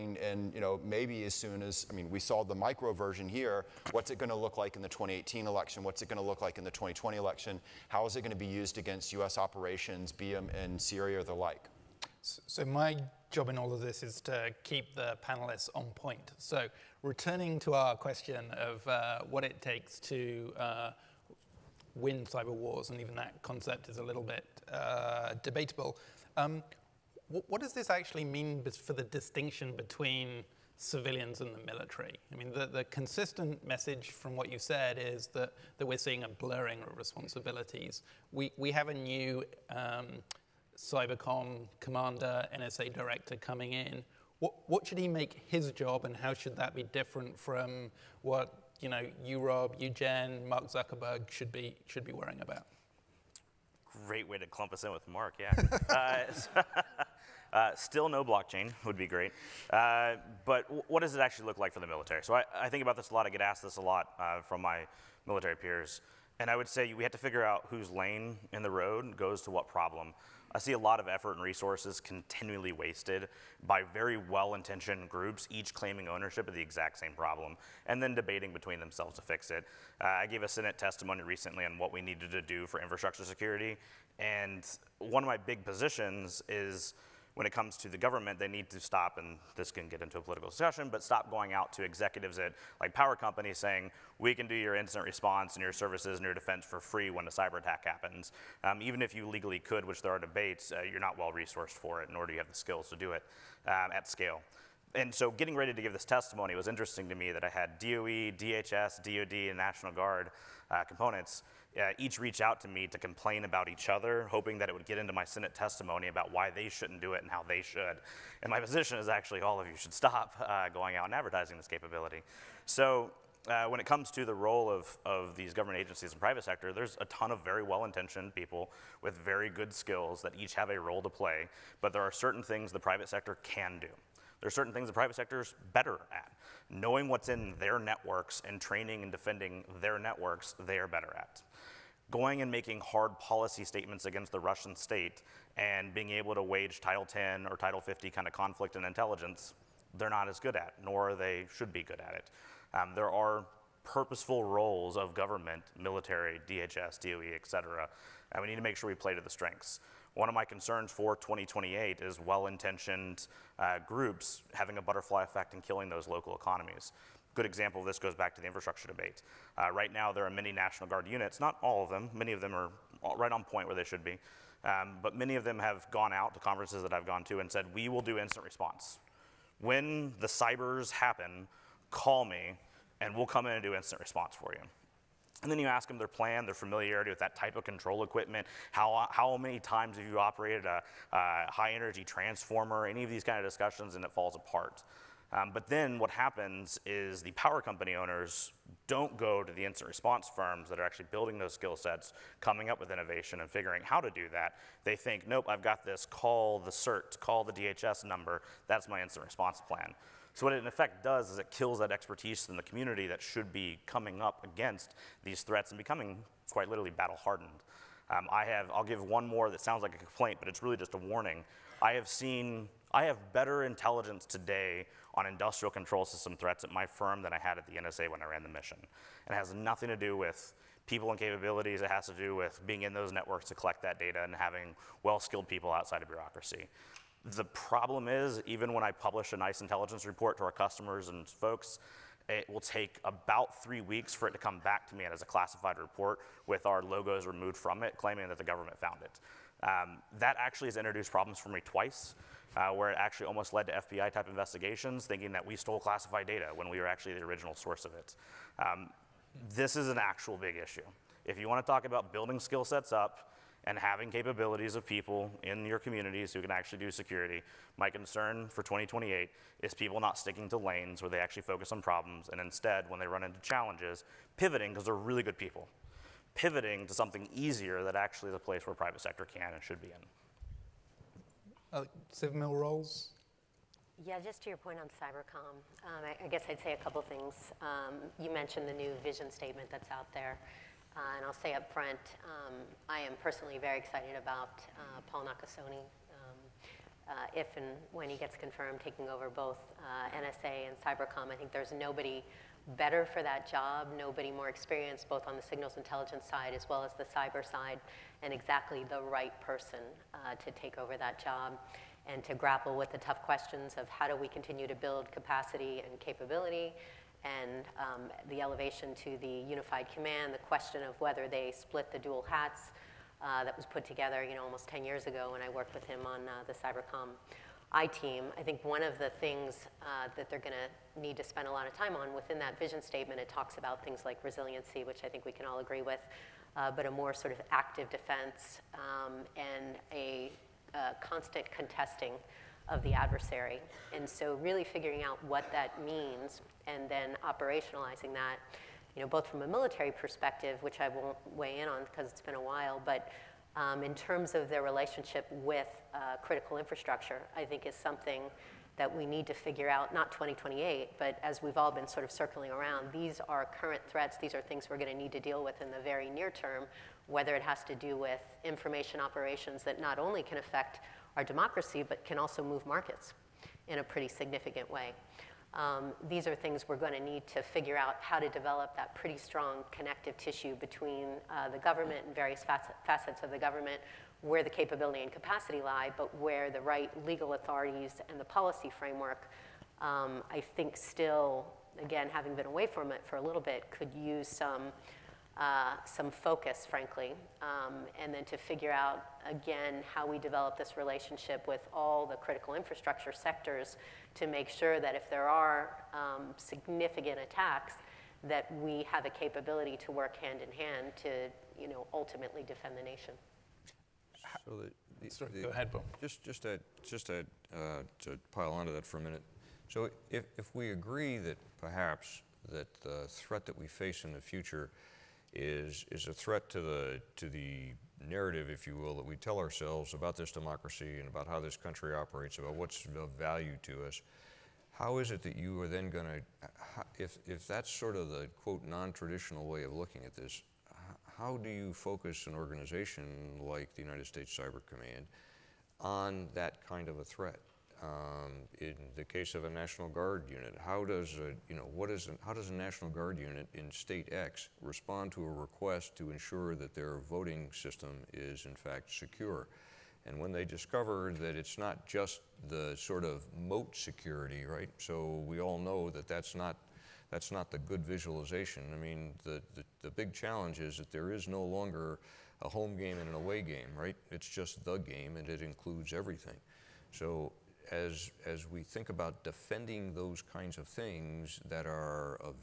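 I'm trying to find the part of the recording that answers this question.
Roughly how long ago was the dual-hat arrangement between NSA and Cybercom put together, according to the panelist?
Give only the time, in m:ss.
5:24.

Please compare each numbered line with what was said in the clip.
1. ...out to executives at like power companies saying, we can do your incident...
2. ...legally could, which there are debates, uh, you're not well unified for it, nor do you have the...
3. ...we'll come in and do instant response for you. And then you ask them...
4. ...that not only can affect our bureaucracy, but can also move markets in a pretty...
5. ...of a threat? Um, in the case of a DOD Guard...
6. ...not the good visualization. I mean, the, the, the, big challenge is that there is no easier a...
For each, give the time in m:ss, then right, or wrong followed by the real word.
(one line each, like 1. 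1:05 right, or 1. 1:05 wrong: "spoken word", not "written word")
1. 1:31 right
2. 1:39 wrong: "resourced", not "unified"
3. 3:03 right
4. 6:09 wrong: "democracy", not "bureaucracy"
5. 7:26 wrong: "National", not "DOD"
6. 7:47 wrong: "longer", not "easier".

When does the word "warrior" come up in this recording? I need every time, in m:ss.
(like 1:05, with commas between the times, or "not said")
not said.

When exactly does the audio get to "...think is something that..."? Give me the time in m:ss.
5:57.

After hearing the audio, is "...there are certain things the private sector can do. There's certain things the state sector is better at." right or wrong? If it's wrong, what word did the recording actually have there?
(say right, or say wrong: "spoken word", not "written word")
wrong: "private", not "state".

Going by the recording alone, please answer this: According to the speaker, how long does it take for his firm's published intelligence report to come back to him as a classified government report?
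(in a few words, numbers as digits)
three weeks.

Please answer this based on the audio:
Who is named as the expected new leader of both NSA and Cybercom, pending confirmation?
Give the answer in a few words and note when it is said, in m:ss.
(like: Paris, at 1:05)
Paul Nakasone, at 4:55.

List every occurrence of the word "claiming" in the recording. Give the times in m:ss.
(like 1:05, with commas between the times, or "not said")
1:15, 4:07.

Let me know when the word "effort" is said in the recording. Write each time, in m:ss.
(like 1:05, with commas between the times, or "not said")
1:11.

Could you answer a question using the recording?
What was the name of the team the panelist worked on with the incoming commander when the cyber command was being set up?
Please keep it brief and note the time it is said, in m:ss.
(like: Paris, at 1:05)
Cybercom I team, at 5:26.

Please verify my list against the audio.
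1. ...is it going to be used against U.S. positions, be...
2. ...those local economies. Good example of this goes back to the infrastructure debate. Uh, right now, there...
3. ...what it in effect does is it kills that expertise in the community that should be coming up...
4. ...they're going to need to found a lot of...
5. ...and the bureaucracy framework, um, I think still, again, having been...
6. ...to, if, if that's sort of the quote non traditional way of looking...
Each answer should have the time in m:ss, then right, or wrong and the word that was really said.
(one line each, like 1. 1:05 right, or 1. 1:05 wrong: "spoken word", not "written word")
1. 0:08 wrong: "operations", not "positions"
2. 2:45 right
3. 3:30 right
4. 5:30 wrong: "spend", not "found"
5. 6:28 wrong: "policy", not "bureaucracy"
6. 7:16 right.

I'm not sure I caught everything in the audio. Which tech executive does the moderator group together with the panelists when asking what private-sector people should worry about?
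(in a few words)
Mark Zuckerberg.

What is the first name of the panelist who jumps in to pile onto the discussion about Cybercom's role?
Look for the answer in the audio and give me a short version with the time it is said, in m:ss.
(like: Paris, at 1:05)
Bill, at 6:55.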